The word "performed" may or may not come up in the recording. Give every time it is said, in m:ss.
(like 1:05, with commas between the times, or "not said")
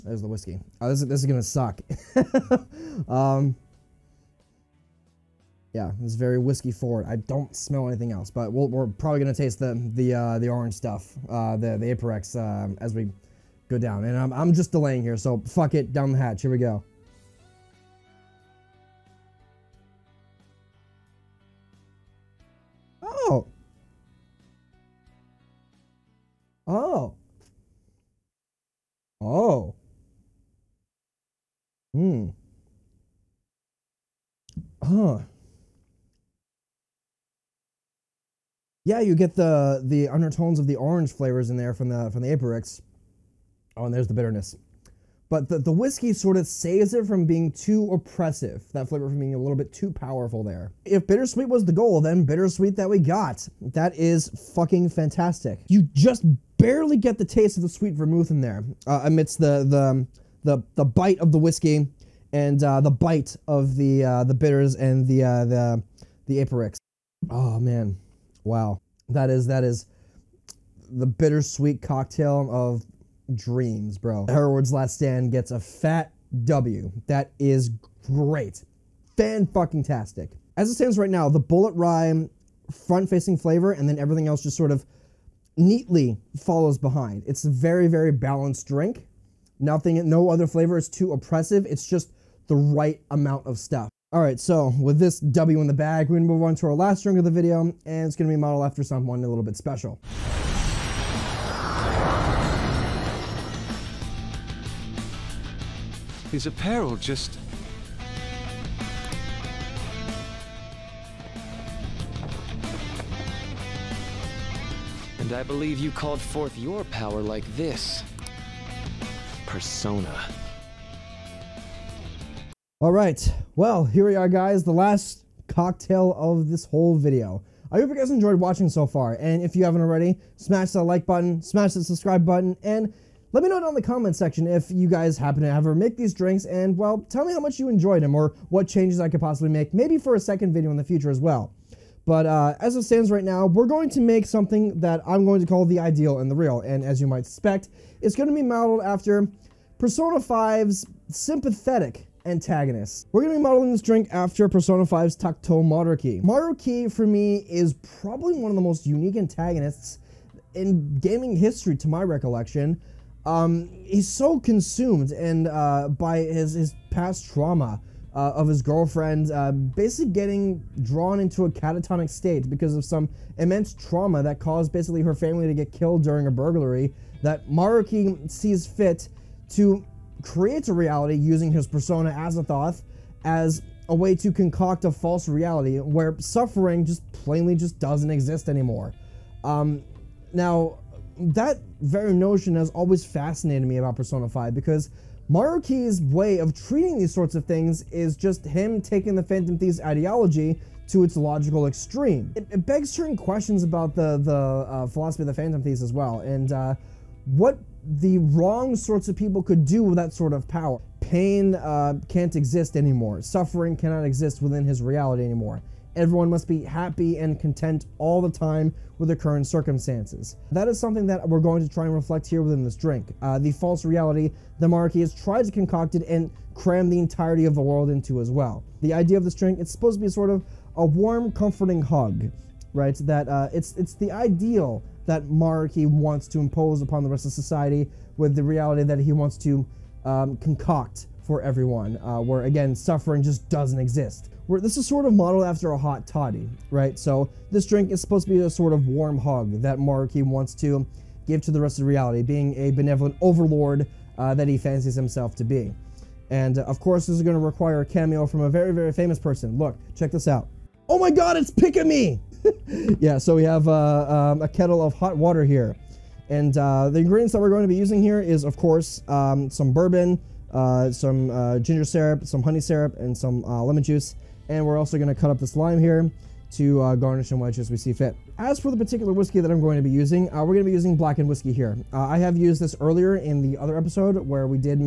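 not said.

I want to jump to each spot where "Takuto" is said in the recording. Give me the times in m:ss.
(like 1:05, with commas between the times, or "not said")
2:35.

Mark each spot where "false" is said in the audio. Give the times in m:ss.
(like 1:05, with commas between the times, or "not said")
3:04, 3:43.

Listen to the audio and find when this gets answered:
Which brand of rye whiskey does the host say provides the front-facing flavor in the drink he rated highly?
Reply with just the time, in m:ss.
1:21.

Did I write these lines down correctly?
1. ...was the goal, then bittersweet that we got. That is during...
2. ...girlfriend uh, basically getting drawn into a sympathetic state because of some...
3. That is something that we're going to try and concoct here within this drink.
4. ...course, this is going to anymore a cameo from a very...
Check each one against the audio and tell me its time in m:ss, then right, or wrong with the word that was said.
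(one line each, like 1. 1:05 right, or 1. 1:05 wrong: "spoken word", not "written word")
1. 0:51 wrong: "fucking", not "during"
2. 2:48 wrong: "catatonic", not "sympathetic"
3. 3:40 wrong: "reflect", not "concoct"
4. 4:16 wrong: "require", not "anymore".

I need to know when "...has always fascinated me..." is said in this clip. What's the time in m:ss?
3:12.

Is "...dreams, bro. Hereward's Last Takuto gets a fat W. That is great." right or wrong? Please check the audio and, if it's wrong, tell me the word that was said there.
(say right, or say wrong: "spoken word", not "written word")
wrong: "Stand", not "Takuto".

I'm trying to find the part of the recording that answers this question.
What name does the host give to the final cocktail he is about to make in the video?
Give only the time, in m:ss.
2:25.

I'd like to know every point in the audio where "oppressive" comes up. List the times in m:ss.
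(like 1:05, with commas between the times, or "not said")
0:47, 1:31.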